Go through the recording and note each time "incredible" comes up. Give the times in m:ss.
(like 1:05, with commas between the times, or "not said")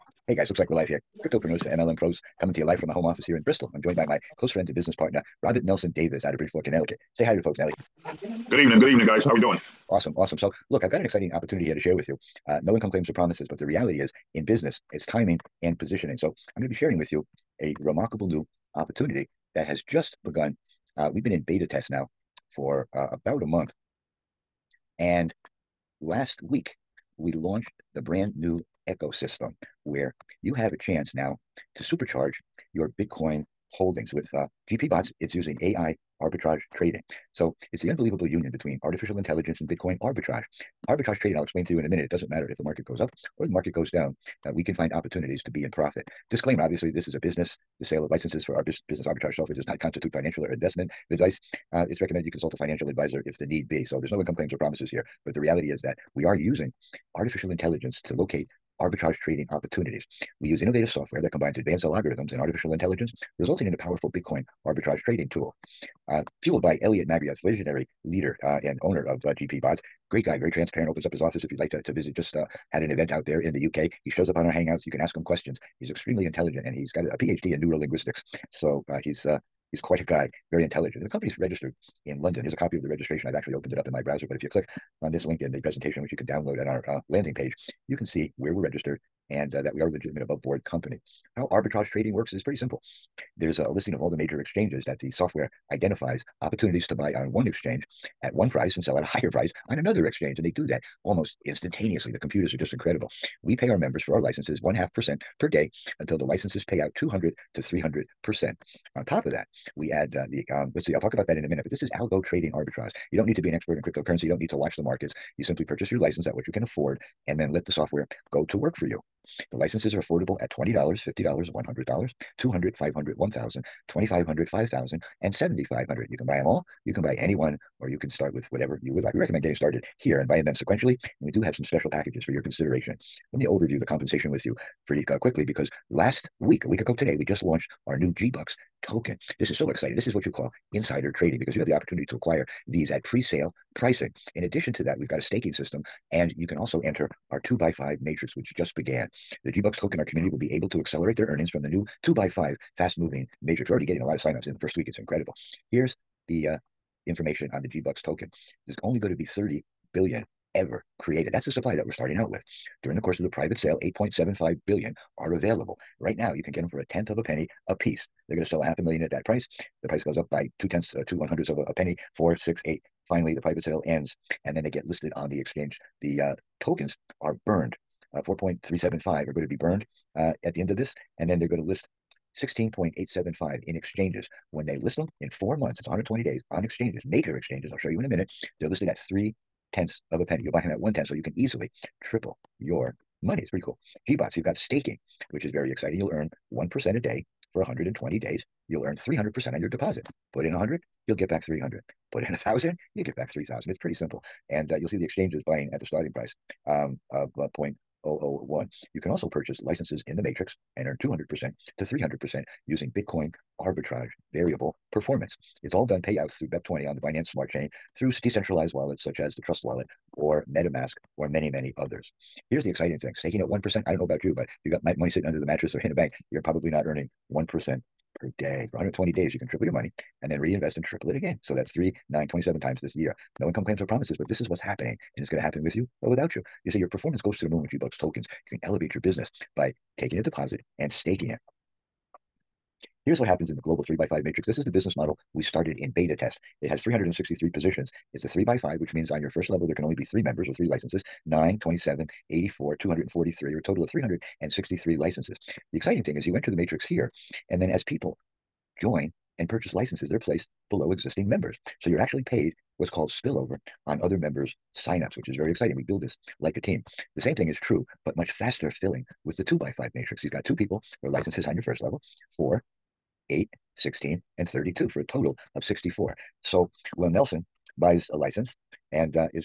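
1:42, 2:34.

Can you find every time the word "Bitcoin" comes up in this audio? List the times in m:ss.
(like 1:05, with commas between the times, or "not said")
0:32, 0:39, 1:04, 3:32.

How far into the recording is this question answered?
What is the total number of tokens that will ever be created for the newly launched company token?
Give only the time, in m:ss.
2:39.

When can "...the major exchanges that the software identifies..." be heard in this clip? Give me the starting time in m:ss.
1:34.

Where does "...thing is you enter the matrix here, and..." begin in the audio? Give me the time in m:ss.
4:16.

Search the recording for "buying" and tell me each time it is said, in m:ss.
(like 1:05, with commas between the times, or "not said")
2:10, 3:25.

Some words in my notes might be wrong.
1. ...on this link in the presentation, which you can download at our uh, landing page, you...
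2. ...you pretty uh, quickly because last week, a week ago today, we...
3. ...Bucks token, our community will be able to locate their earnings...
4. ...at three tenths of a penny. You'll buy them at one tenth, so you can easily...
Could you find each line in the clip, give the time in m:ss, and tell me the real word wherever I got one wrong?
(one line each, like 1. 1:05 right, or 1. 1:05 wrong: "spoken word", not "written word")
1. 1:25 right
2. 2:14 right
3. 2:29 wrong: "accelerate", not "locate"
4. 3:08 right.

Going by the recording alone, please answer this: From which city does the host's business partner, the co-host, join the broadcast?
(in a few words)
Bridgeport, Connecticut.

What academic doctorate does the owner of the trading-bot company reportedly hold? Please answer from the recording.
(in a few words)
PhD in neurolinguistics.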